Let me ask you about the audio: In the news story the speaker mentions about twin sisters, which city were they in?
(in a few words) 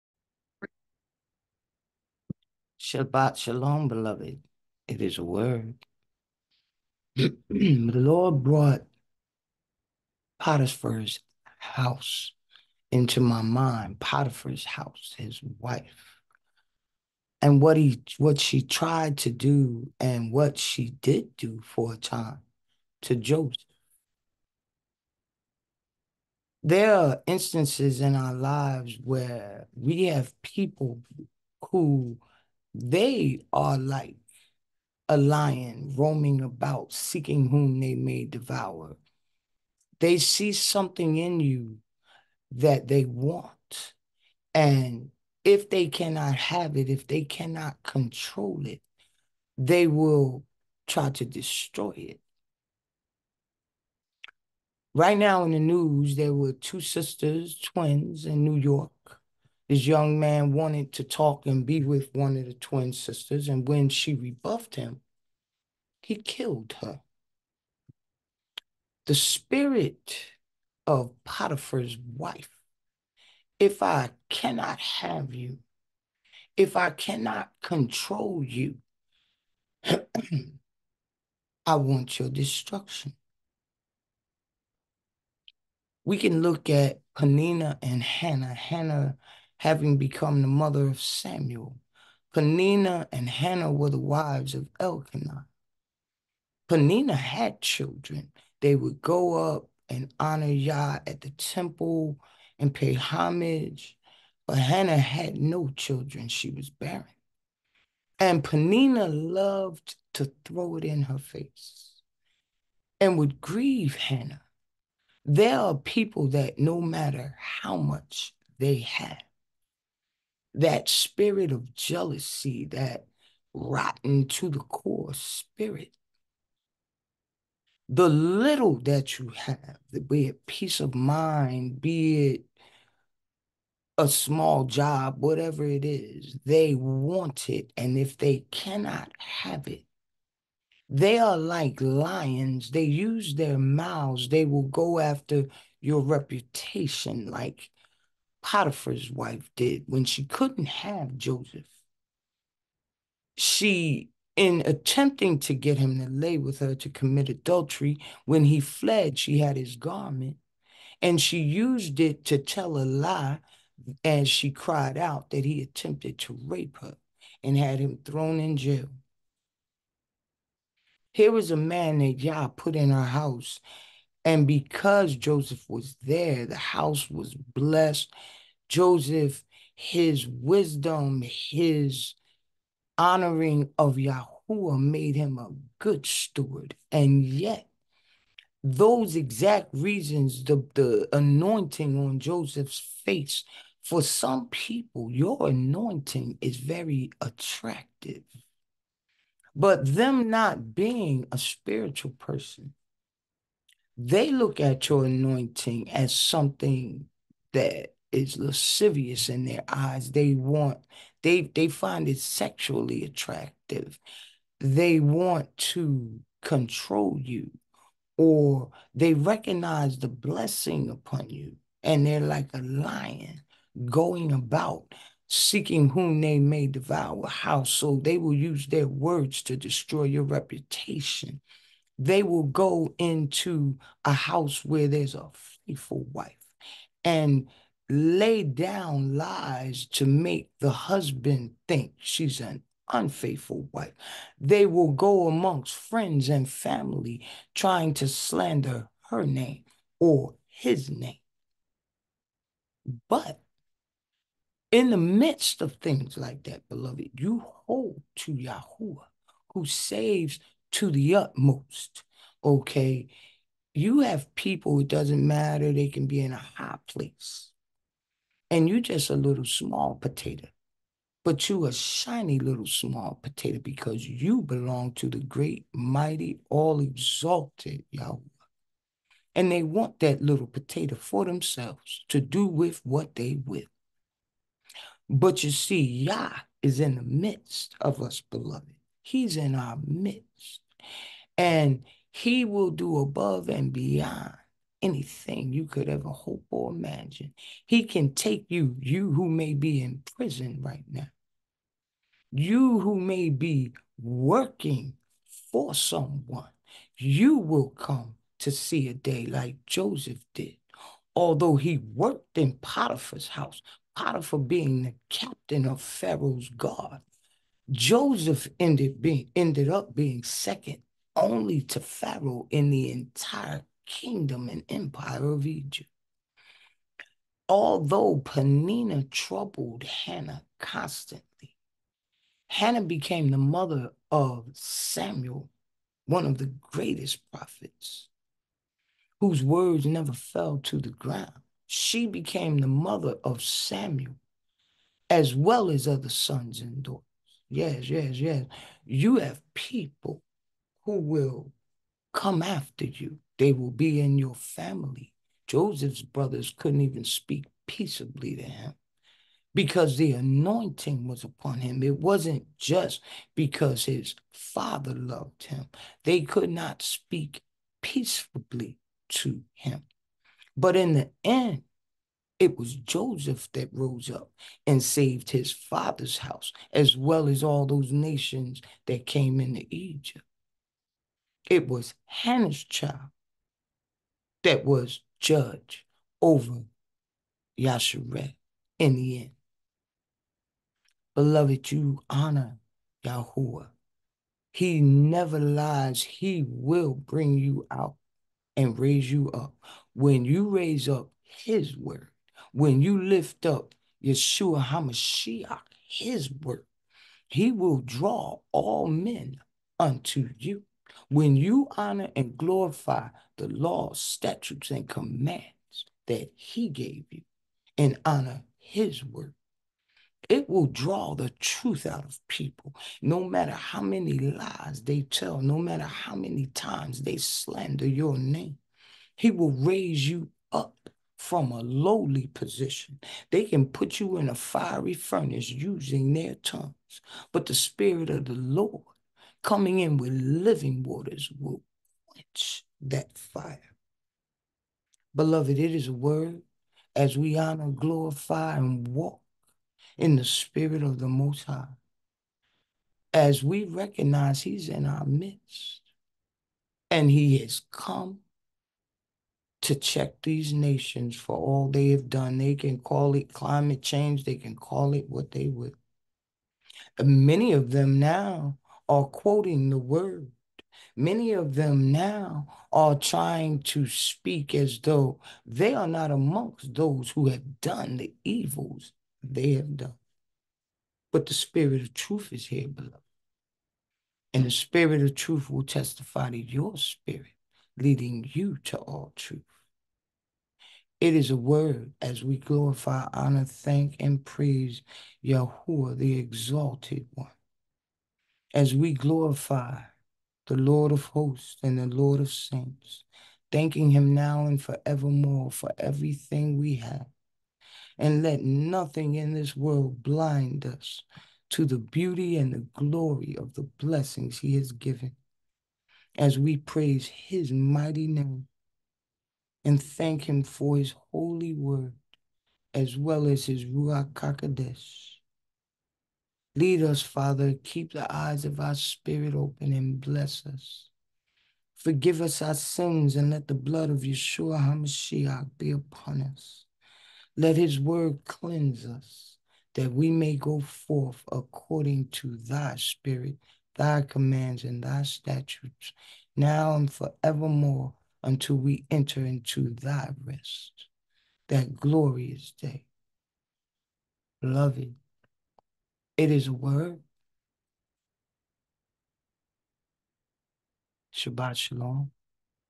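New York.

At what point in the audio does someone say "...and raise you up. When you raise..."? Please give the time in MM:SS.
06:38.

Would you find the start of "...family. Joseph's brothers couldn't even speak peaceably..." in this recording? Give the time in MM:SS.
05:54.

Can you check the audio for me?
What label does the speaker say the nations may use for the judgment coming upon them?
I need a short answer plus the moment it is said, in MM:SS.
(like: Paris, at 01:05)
climate change, at 07:43.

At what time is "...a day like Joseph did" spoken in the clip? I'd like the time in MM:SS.
05:08.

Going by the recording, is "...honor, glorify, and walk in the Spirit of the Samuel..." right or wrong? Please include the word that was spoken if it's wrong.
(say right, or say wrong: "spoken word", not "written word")
wrong: "Most", not "Samuel".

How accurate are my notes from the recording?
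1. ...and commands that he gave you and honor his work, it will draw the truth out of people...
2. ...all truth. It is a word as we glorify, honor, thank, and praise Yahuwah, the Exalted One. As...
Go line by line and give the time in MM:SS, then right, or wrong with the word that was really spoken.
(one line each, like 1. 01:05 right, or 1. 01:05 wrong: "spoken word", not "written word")
1. 06:54 right
2. 08:08 right.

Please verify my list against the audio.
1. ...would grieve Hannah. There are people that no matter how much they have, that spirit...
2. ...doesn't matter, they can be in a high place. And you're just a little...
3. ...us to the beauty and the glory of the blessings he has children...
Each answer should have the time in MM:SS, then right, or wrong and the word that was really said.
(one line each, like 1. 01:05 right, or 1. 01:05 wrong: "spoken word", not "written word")
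1. 01:53 right
2. 04:24 right
3. 08:30 wrong: "given", not "children".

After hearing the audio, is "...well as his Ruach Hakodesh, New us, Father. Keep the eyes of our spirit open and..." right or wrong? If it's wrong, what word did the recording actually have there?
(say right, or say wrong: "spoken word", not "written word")
wrong: "Lead", not "New".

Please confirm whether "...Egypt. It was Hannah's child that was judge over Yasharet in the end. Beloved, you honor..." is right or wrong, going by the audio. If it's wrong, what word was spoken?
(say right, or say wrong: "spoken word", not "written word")
right.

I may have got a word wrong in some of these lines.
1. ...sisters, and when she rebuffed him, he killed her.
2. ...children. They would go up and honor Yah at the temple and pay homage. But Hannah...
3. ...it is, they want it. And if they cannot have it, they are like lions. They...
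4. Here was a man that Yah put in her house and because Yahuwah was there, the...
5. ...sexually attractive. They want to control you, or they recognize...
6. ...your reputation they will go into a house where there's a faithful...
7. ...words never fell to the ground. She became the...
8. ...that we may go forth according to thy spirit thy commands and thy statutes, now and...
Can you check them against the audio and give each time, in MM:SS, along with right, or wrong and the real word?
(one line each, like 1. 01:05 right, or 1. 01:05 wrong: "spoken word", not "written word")
1. 01:02 right
2. 01:37 right
3. 02:15 right
4. 02:51 wrong: "Joseph", not "Yahuwah"
5. 03:32 right
6. 03:50 right
7. 05:39 right
8. 08:59 right.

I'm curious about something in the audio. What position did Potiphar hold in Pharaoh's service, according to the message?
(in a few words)
captain of Pharaoh's guard.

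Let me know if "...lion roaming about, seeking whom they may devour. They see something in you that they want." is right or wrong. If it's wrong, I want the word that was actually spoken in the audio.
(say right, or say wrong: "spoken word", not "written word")
right.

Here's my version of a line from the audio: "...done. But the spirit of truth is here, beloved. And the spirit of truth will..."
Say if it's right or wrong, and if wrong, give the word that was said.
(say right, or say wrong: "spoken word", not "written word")
right.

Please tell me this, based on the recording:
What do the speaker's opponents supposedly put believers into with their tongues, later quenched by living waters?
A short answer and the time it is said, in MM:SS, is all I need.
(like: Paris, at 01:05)
fiery furnace, at 07:14.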